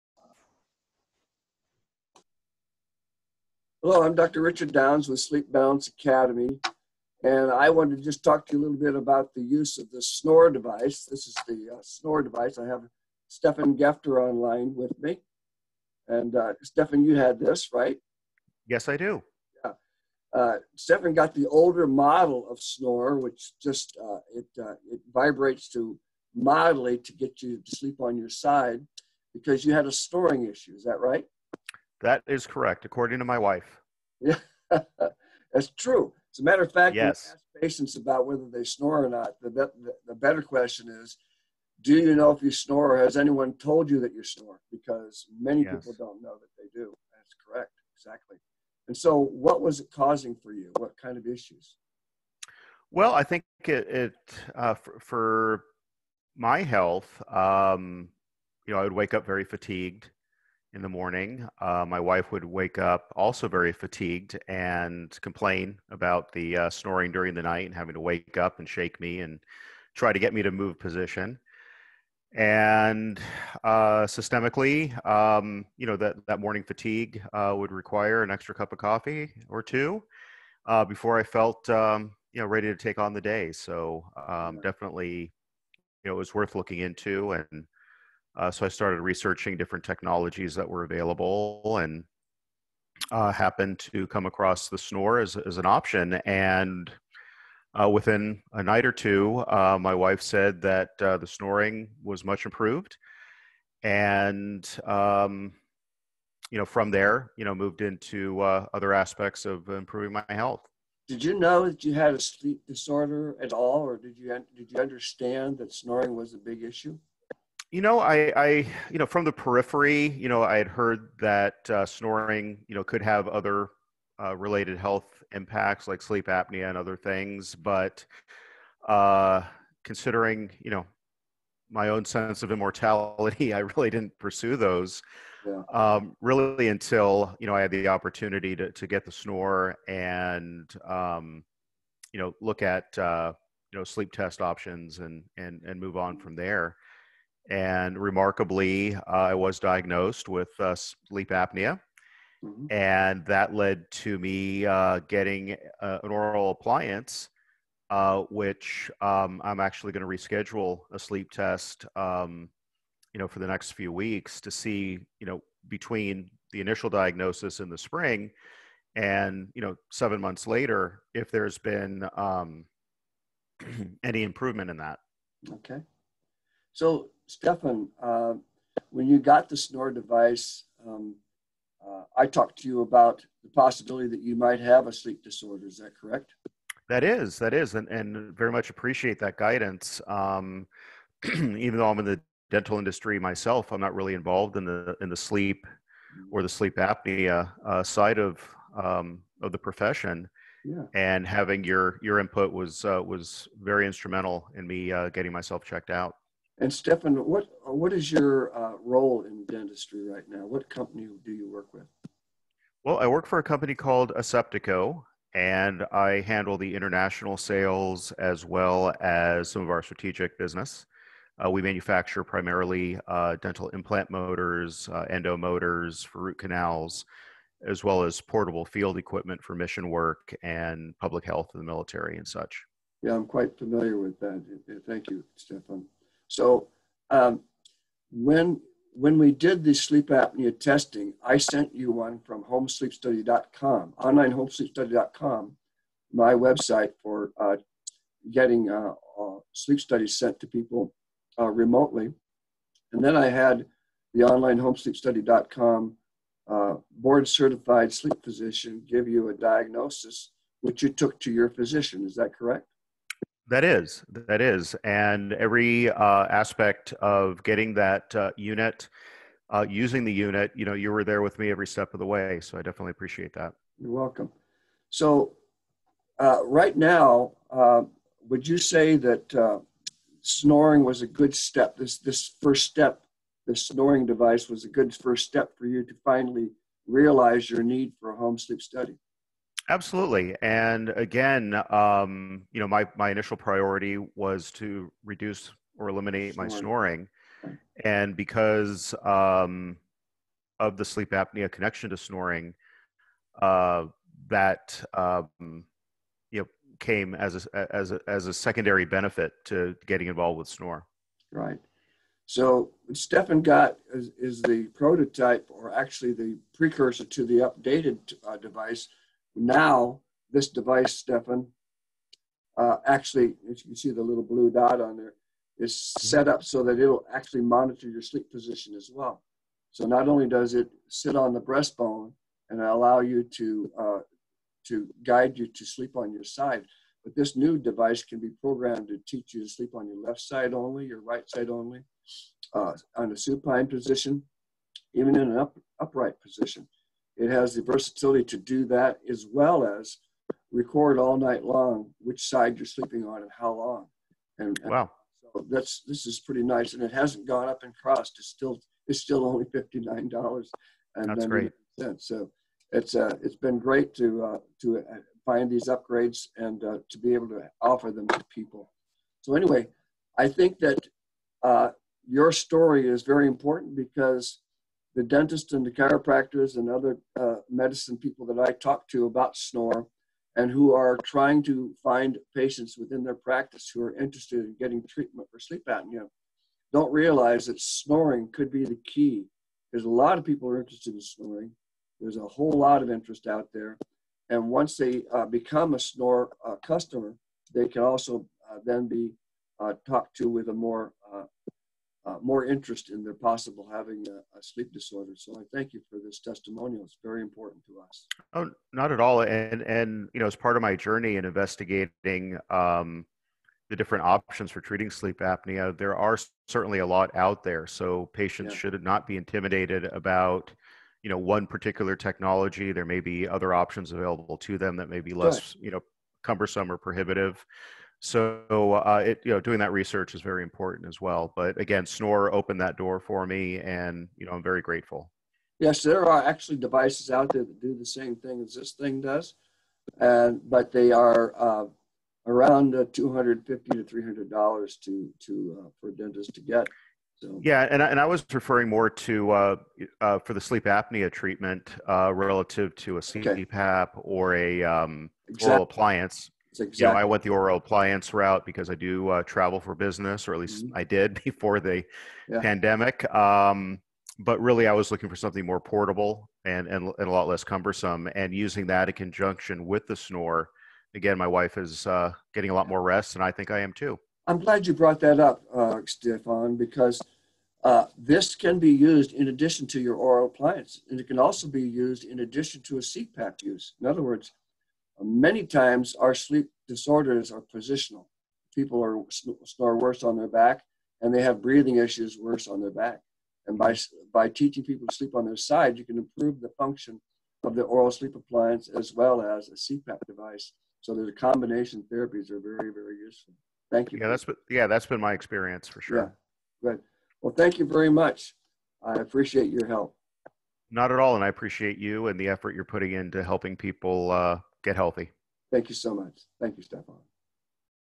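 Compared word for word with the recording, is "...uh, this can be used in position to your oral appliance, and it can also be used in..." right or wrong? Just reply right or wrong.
wrong.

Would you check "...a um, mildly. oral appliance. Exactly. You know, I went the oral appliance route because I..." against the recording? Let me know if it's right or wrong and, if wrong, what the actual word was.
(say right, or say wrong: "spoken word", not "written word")
wrong: "exactly", not "mildly".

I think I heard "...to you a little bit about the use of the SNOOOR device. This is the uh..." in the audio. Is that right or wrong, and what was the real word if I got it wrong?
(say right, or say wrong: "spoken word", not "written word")
right.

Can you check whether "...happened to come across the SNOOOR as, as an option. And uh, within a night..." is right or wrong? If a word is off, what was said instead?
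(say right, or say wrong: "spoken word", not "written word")
right.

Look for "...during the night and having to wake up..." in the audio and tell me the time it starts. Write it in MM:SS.
01:07.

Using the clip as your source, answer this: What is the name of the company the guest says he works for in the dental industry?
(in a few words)
Aseptico.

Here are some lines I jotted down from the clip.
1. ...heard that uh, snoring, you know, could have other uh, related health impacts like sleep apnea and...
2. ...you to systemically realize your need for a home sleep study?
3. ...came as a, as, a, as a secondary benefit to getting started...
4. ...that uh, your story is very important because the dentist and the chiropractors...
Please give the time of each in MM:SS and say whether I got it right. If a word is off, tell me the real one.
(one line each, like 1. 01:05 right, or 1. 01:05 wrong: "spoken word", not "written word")
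1. 02:00 right
2. 04:45 wrong: "finally", not "systemically"
3. 05:06 wrong: "involved", not "started"
4. 06:10 right.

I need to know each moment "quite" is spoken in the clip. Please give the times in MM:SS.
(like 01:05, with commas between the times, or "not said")
03:53.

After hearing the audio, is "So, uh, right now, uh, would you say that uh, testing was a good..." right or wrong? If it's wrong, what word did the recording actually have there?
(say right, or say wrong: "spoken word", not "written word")
wrong: "snoring", not "testing".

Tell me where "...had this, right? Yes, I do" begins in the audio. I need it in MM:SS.
00:17.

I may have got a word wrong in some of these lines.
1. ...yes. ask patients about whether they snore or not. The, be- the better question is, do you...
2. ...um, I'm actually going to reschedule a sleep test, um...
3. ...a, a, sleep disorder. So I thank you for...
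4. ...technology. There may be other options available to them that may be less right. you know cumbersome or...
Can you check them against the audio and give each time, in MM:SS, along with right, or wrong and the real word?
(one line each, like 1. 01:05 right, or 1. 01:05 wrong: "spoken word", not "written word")
1. 00:36 right
2. 02:39 right
3. 06:44 right
4. 07:01 right.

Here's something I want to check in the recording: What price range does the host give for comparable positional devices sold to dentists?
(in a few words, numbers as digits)
$250 to $300.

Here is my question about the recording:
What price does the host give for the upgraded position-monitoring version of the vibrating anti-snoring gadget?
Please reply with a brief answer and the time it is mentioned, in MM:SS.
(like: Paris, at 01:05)
$59, at 05:59.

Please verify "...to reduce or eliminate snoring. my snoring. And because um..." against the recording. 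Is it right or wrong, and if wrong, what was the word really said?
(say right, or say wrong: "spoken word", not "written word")
right.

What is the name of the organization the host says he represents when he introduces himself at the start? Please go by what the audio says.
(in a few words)
Sleep Balance Academy.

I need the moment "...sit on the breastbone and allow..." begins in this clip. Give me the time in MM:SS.
05:30.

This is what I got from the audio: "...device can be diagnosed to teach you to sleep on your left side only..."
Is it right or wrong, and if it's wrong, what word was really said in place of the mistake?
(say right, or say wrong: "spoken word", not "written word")
wrong: "programmed", not "diagnosed".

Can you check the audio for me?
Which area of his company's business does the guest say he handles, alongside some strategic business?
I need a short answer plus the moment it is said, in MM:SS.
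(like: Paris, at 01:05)
International sales, at 03:36.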